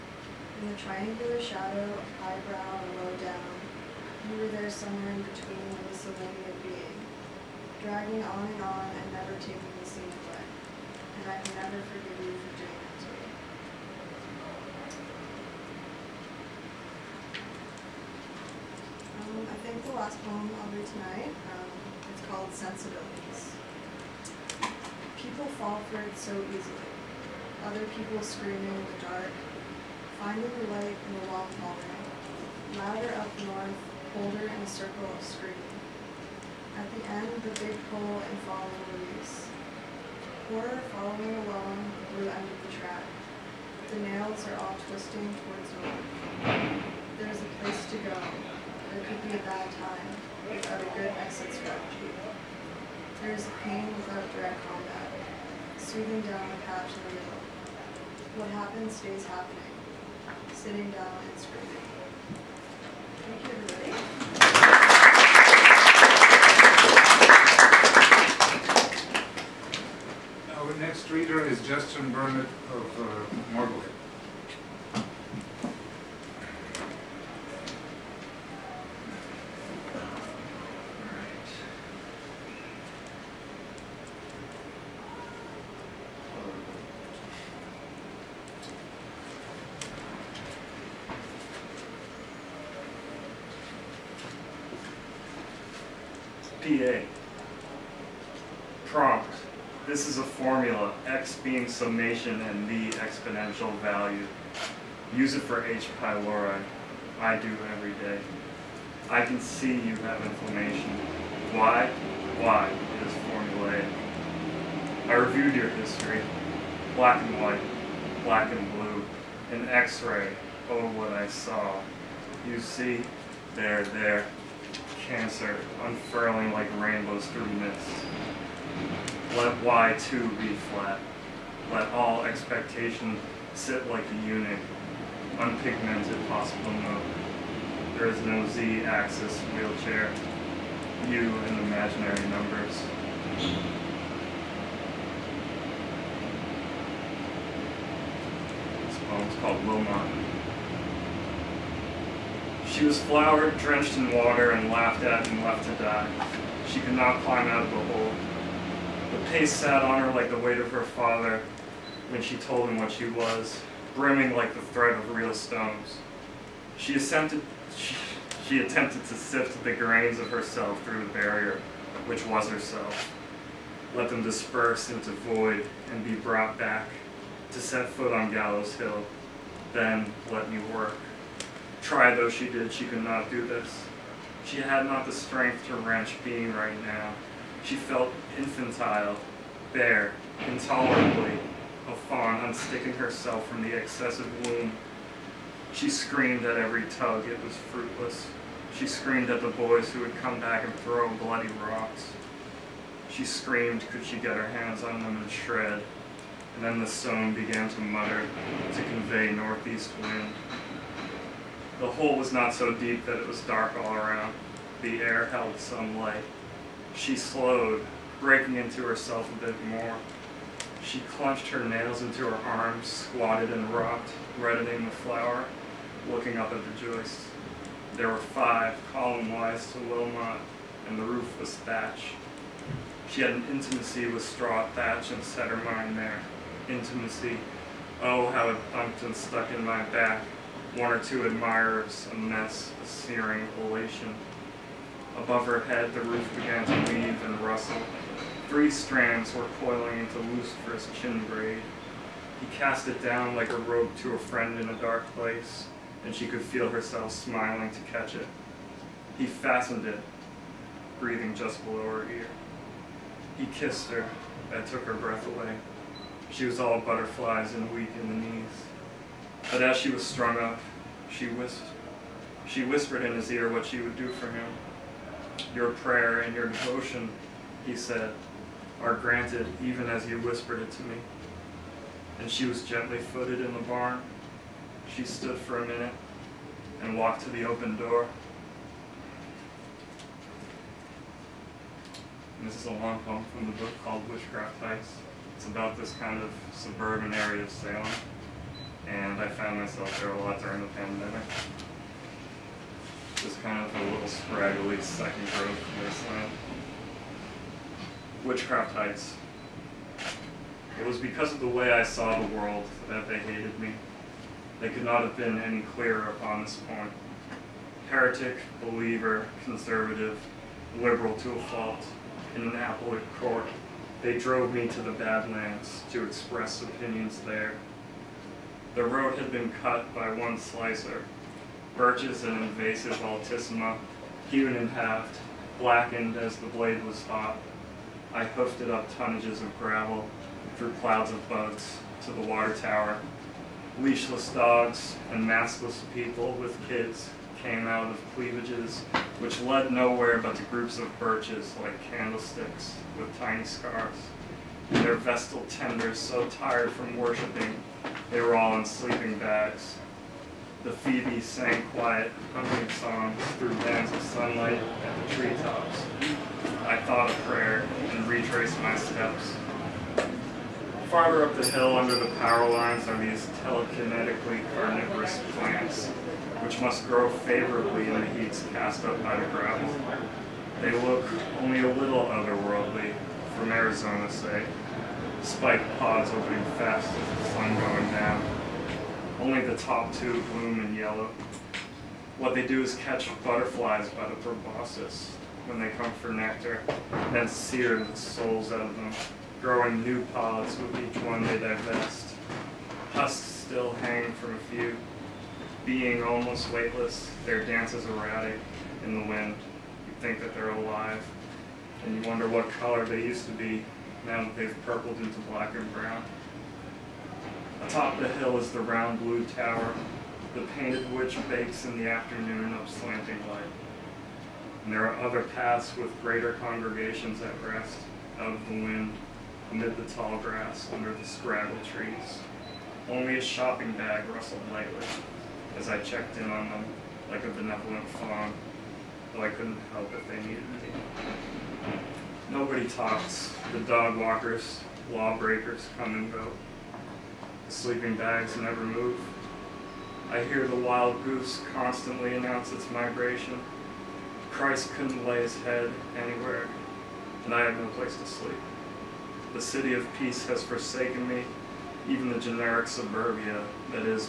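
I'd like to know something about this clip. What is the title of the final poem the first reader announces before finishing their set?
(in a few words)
Sensibilities.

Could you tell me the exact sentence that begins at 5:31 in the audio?
Birches and invasive altissima, hewn in half, blackened as the blade was hot.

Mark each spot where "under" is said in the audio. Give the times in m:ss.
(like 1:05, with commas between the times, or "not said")
6:11, 7:10.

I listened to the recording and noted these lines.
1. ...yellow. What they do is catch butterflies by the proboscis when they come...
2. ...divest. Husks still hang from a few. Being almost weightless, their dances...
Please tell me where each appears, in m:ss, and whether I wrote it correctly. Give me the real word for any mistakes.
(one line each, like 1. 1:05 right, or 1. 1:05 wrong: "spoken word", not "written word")
1. 6:30 right
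2. 6:41 right.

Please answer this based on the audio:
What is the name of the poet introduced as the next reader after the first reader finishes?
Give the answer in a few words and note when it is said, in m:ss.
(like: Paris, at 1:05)
Justin Burnett, at 1:11.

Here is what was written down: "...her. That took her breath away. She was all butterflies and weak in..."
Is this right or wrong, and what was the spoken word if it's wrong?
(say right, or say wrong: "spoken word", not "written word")
right.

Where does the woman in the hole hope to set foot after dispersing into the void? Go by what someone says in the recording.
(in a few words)
Gallows Hill.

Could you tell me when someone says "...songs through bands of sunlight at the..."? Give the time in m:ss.
6:02.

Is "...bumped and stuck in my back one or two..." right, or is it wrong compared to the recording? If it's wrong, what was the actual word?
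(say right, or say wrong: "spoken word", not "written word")
right.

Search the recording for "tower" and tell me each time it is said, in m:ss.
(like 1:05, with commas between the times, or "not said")
5:42, 6:59.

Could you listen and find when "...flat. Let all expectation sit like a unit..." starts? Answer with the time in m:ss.
2:10.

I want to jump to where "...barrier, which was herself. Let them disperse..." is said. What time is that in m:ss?
2:51.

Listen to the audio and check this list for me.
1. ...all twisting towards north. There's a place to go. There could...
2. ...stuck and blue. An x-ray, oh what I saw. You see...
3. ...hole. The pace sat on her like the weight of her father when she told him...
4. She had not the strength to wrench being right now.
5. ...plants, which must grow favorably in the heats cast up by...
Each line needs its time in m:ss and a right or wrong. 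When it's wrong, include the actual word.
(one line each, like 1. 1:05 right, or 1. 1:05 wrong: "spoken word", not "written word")
1. 0:44 right
2. 1:58 wrong: "black", not "stuck"
3. 2:37 right
4. 3:04 right
5. 6:15 right.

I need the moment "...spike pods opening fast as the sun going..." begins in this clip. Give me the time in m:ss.
6:25.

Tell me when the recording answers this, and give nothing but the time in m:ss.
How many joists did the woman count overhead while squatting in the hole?
3:48.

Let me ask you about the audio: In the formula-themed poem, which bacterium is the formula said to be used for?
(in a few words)
H. pylori.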